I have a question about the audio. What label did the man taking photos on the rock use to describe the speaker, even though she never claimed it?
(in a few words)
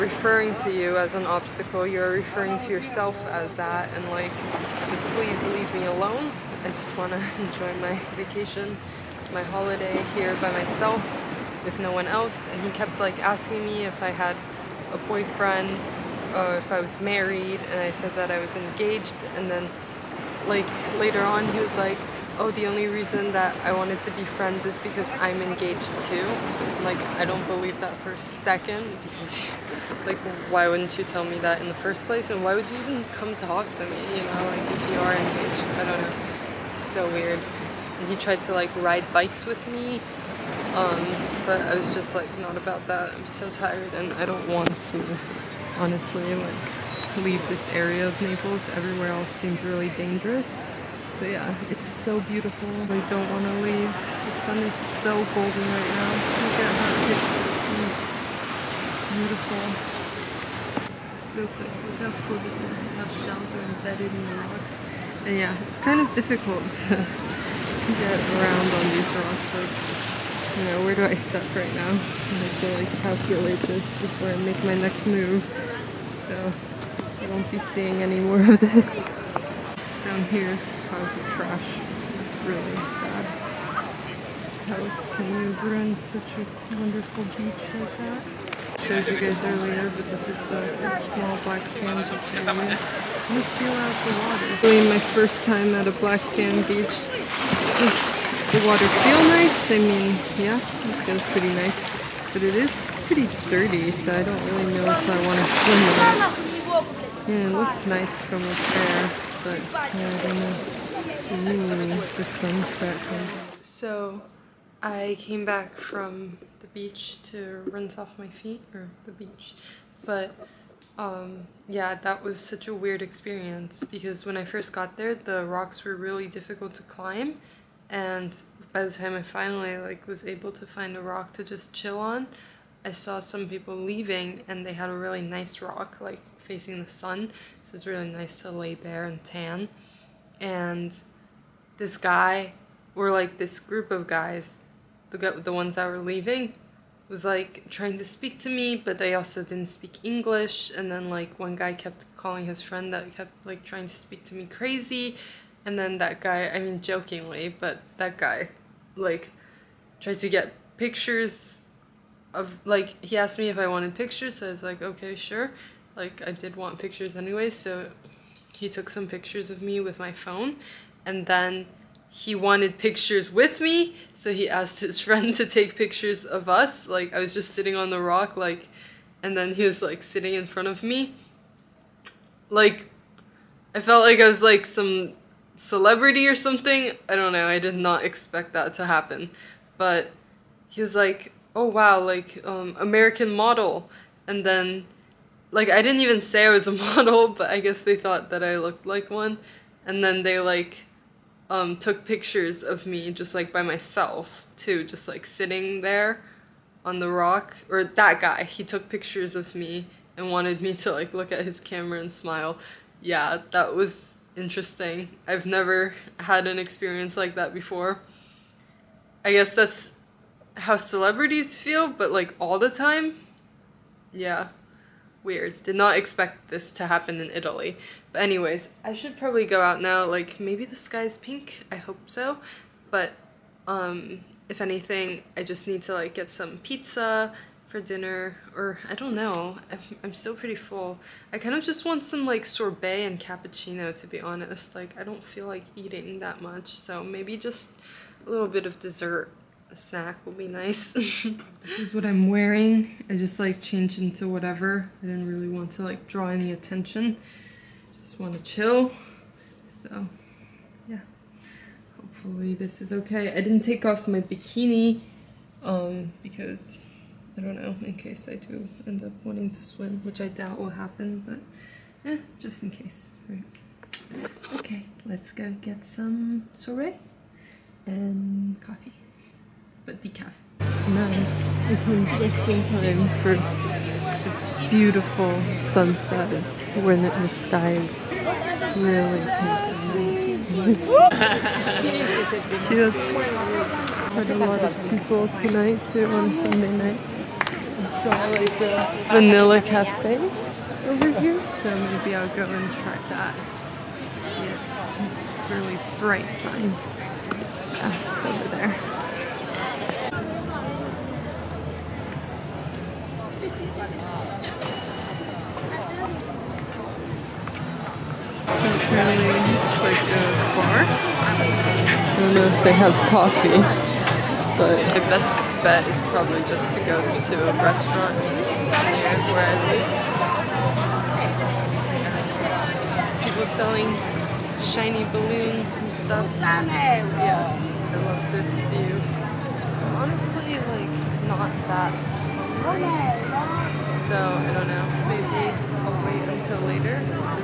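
American model.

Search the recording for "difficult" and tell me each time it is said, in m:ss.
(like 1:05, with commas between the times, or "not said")
1:06, 2:06.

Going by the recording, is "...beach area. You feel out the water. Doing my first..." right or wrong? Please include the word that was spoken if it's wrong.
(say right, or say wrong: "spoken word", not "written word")
right.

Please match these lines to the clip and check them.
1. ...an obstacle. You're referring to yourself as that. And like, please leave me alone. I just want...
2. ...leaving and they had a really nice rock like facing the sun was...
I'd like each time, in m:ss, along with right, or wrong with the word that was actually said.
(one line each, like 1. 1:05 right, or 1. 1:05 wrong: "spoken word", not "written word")
1. 0:01 right
2. 2:13 right.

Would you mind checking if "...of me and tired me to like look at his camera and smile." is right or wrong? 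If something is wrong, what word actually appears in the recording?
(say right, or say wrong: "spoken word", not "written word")
wrong: "wanted", not "tired".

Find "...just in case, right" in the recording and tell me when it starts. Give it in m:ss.
4:32.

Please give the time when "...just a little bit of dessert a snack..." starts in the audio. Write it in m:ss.
4:07.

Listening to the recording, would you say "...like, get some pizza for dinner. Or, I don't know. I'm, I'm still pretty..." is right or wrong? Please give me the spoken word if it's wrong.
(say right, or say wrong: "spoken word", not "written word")
right.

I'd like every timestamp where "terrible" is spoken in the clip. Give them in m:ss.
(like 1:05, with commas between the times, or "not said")
not said.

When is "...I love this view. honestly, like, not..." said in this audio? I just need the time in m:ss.
5:37.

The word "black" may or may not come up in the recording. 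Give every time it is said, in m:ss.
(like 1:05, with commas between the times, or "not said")
1:31, 1:35.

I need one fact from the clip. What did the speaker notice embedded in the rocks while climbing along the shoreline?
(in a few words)
Shells.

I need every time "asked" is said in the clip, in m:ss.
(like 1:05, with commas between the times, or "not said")
2:43, 2:54.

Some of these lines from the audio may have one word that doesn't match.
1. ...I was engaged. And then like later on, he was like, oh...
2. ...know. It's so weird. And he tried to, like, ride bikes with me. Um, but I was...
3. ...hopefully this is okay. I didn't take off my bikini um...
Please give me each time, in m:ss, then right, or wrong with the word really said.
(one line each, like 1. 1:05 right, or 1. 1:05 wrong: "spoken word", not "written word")
1. 0:18 right
2. 0:36 right
3. 4:22 right.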